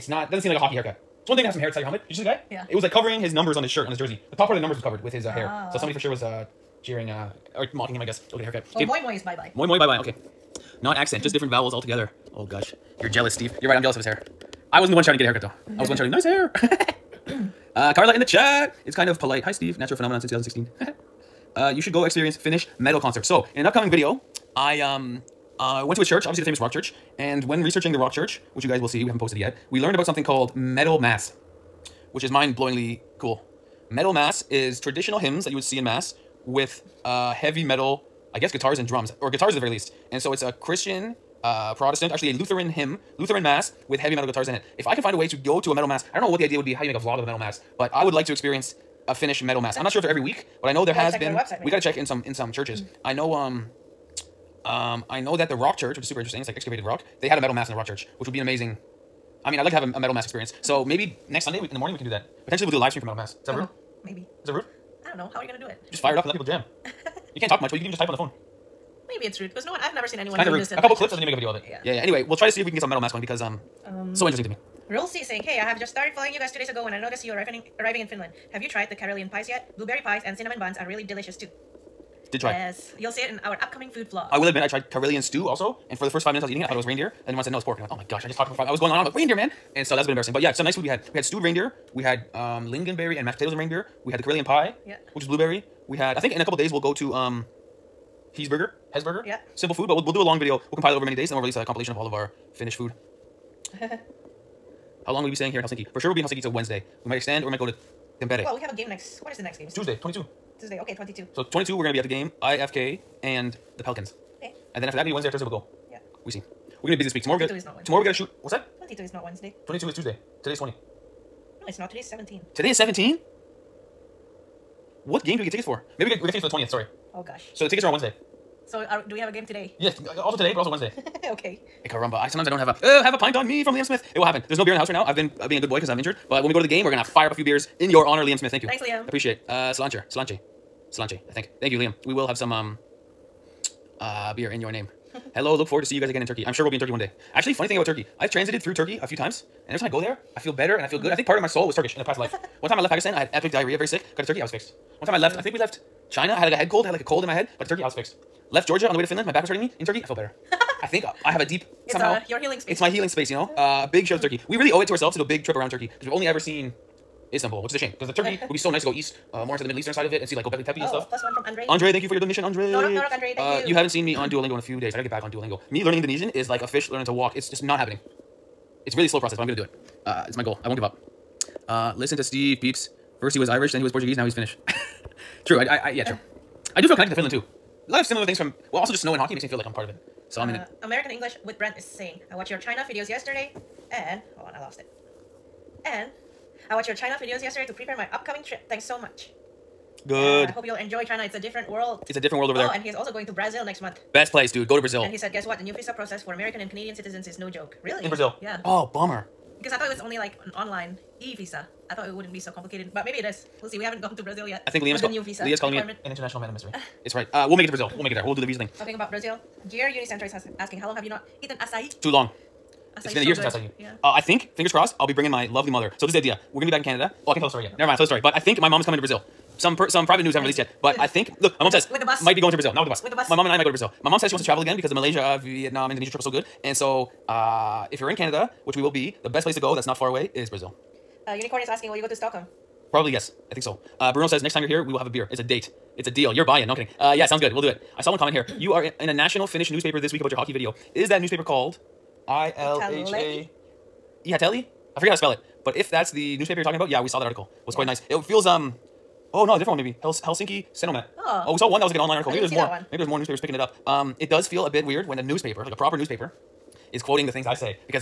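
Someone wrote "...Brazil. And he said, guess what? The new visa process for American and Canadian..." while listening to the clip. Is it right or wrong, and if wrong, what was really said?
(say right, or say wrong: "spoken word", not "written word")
right.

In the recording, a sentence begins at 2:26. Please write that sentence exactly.
I'm sure we'll be in Turkey one day.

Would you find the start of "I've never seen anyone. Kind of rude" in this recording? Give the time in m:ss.
1:09.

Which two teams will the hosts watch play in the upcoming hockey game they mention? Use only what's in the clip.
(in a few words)
IFK and the Pelicans.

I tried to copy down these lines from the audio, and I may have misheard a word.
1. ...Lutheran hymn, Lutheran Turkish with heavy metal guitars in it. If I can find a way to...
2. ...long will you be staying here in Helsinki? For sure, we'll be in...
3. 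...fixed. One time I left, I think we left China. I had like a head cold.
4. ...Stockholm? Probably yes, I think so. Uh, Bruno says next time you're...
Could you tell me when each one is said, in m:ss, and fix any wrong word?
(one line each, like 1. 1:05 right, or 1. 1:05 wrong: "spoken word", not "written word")
1. 0:42 wrong: "Mass", not "Turkish"
2. 1:45 right
3. 2:34 right
4. 4:02 right.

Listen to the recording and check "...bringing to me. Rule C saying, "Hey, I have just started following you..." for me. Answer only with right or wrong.
wrong.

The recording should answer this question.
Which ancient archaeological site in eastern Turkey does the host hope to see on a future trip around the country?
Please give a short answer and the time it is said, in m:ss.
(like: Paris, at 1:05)
Gobekli Tepe, at 2:50.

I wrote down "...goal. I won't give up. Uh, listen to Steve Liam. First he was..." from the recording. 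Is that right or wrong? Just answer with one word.
wrong.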